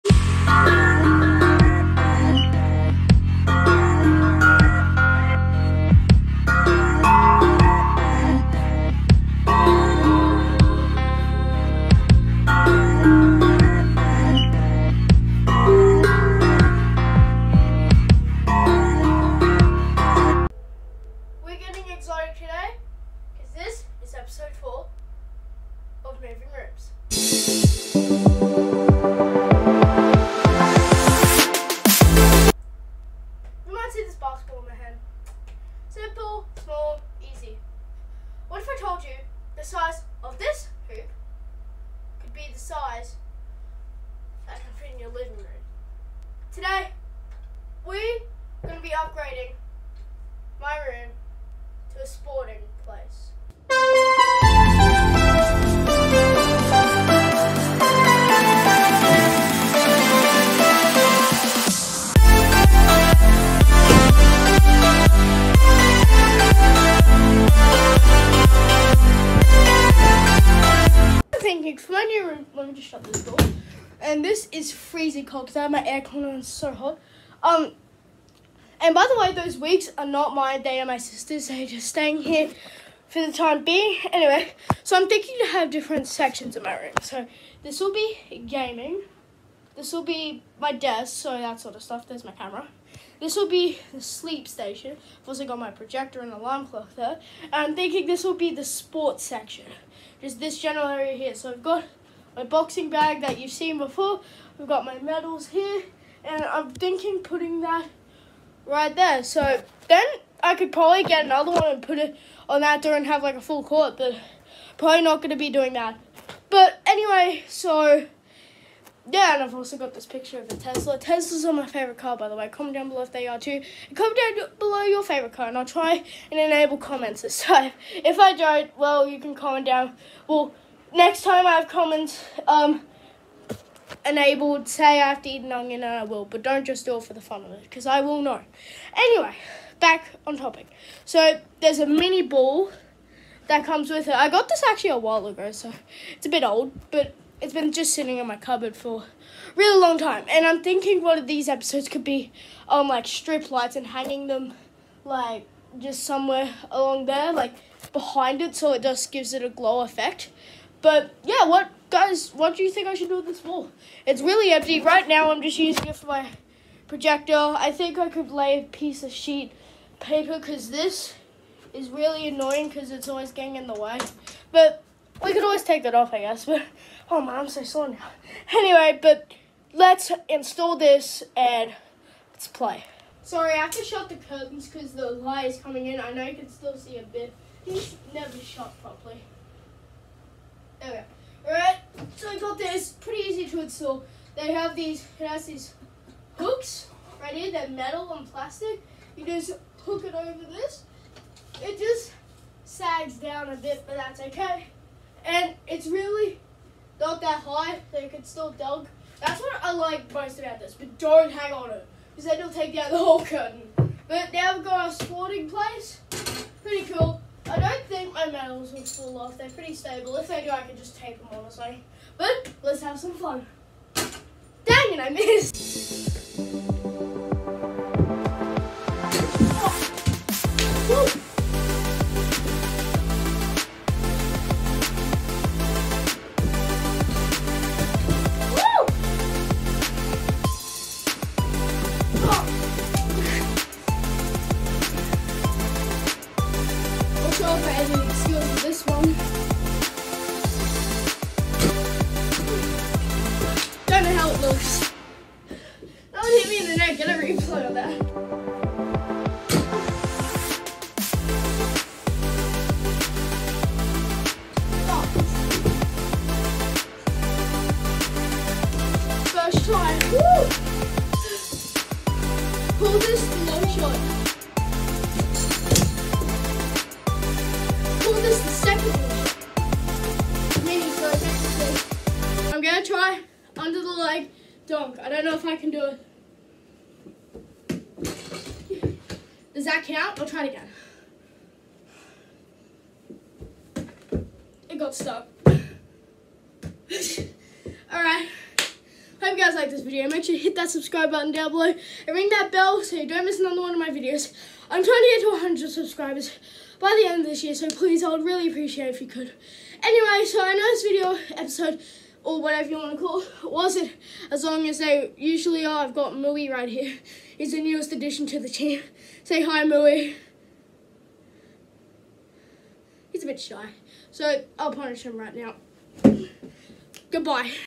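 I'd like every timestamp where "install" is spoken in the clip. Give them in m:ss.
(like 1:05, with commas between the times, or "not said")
3:00, 3:13.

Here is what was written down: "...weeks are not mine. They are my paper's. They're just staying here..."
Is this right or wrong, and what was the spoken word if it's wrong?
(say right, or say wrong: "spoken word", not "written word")
wrong: "sister", not "paper".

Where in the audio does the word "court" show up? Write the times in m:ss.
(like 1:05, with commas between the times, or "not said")
1:53.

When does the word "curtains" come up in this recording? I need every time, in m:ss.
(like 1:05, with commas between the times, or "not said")
3:04, 3:33.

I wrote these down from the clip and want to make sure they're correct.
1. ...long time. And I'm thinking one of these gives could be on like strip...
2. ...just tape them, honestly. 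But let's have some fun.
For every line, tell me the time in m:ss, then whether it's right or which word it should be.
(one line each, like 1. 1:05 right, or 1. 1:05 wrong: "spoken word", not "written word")
1. 2:29 wrong: "episodes", not "gives"
2. 3:40 right.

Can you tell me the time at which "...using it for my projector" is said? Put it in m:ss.
2:45.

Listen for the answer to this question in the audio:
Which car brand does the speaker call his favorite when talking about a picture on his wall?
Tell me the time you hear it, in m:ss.
2:00.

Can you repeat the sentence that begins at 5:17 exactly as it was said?
He's the newest addition to the team.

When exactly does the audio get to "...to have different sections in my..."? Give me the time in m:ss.
1:25.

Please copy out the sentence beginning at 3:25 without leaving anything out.
And it's really not that high, They can still dunk.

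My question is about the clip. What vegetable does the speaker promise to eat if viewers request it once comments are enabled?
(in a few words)
An onion.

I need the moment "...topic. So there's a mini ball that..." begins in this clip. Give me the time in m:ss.
2:20.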